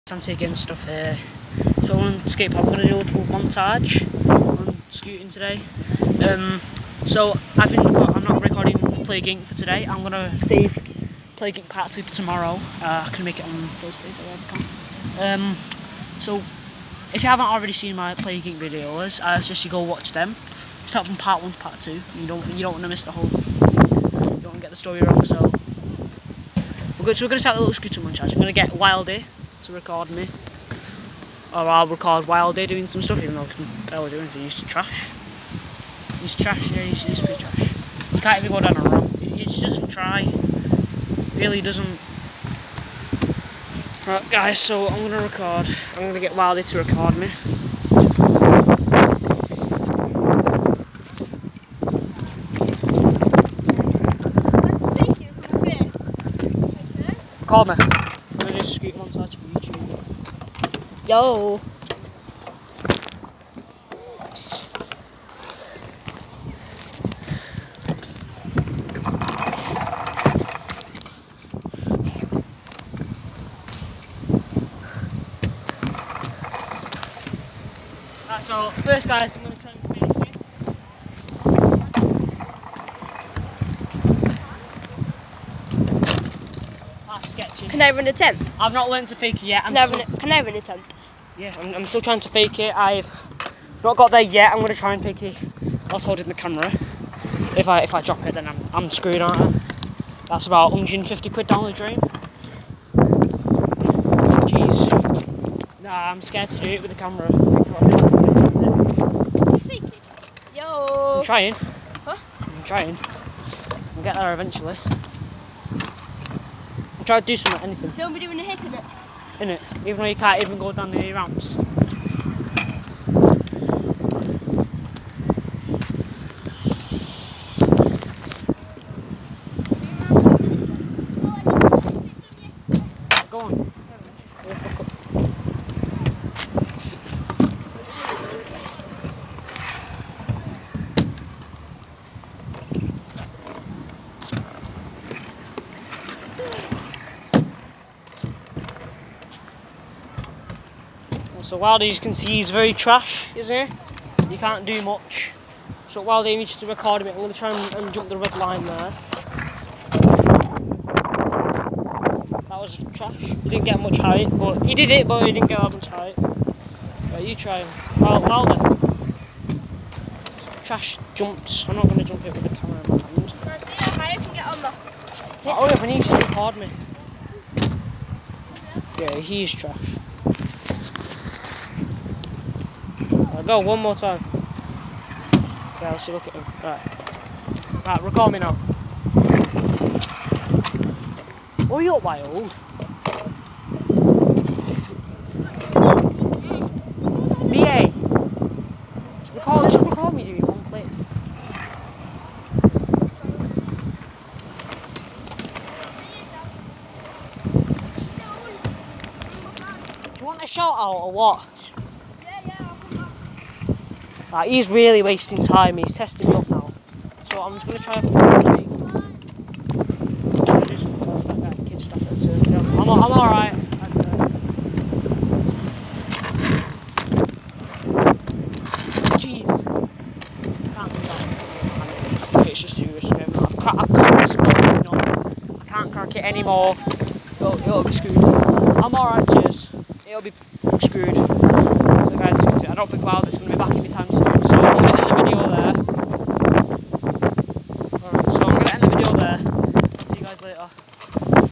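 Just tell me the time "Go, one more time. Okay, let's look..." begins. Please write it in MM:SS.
03:03.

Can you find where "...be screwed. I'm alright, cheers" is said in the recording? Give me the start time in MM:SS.
03:57.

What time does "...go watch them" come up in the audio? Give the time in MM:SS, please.
00:19.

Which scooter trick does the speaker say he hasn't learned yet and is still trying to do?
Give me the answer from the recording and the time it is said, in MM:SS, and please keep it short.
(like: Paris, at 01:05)
Fakie, at 01:29.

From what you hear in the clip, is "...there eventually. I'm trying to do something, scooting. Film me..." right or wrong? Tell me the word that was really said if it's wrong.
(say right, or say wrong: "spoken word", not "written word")
wrong: "anything", not "scooting".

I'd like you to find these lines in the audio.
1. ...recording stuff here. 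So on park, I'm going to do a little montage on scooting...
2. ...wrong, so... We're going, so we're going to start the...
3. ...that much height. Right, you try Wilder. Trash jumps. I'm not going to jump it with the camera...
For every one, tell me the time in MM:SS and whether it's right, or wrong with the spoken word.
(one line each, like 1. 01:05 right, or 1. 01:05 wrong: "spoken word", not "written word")
1. 00:00 wrong: "taking", not "recording"
2. 00:25 right
3. 02:45 right.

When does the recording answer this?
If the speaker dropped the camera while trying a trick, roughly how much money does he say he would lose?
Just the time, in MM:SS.
01:40.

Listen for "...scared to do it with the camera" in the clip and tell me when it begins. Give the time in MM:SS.
01:46.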